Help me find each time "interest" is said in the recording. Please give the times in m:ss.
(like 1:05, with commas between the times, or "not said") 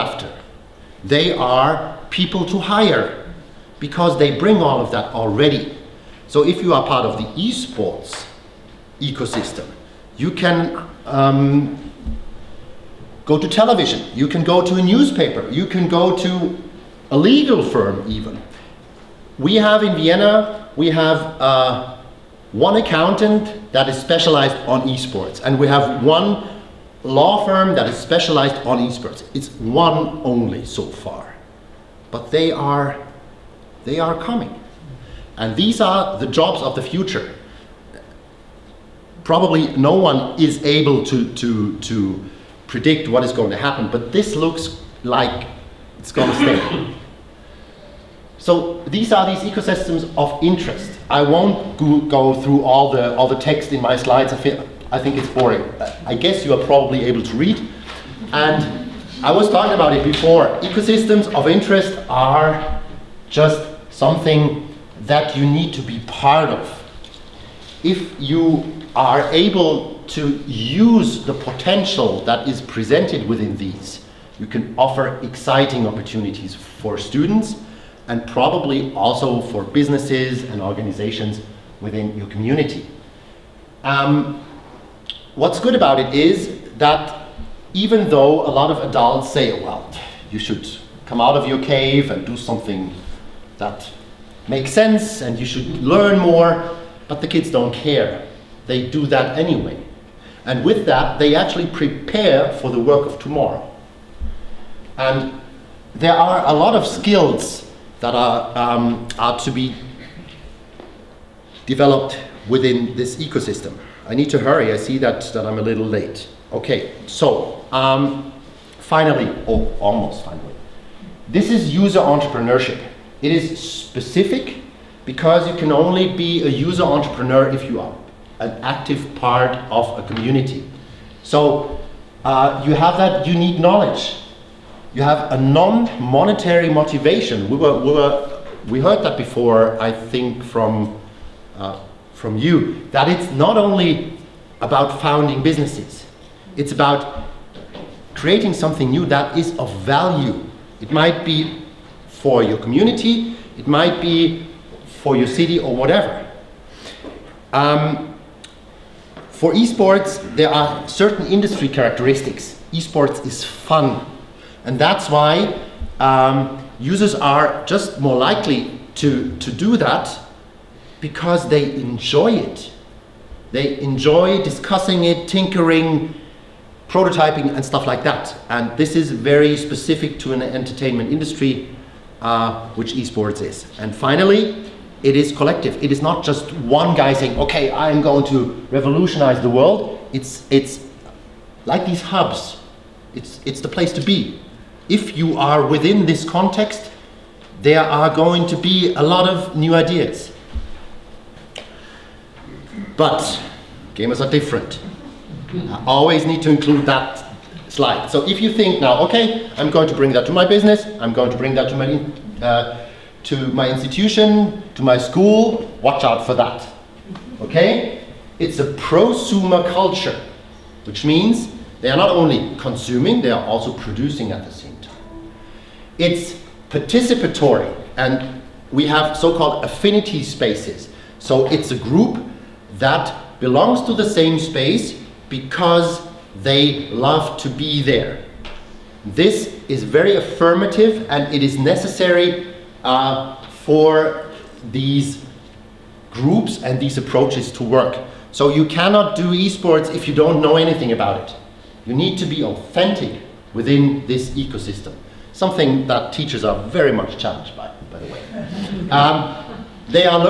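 0:50, 1:01.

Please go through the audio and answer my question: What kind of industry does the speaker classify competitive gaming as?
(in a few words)
Entertainment industry.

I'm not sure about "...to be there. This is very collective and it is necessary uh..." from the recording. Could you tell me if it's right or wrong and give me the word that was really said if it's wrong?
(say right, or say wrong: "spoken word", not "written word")
wrong: "affirmative", not "collective".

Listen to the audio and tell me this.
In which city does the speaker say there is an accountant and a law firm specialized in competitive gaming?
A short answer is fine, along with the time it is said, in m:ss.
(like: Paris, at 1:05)
Vienna, at 0:19.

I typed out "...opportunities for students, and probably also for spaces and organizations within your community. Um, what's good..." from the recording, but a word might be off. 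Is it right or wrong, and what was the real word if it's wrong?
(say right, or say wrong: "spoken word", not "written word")
wrong: "businesses", not "spaces".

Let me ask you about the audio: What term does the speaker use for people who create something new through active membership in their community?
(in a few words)
User entrepreneurship.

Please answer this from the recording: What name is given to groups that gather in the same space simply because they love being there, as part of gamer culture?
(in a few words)
Affinity spaces.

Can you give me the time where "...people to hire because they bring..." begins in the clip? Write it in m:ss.
0:02.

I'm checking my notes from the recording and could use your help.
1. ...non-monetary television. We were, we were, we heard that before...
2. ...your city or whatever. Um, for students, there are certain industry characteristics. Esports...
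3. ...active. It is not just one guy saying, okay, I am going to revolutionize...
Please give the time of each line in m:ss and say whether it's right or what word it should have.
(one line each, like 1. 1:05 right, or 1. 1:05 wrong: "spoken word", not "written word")
1. 2:15 wrong: "motivation", not "television"
2. 2:35 wrong: "esports", not "students"
3. 3:05 wrong: "collective", not "active".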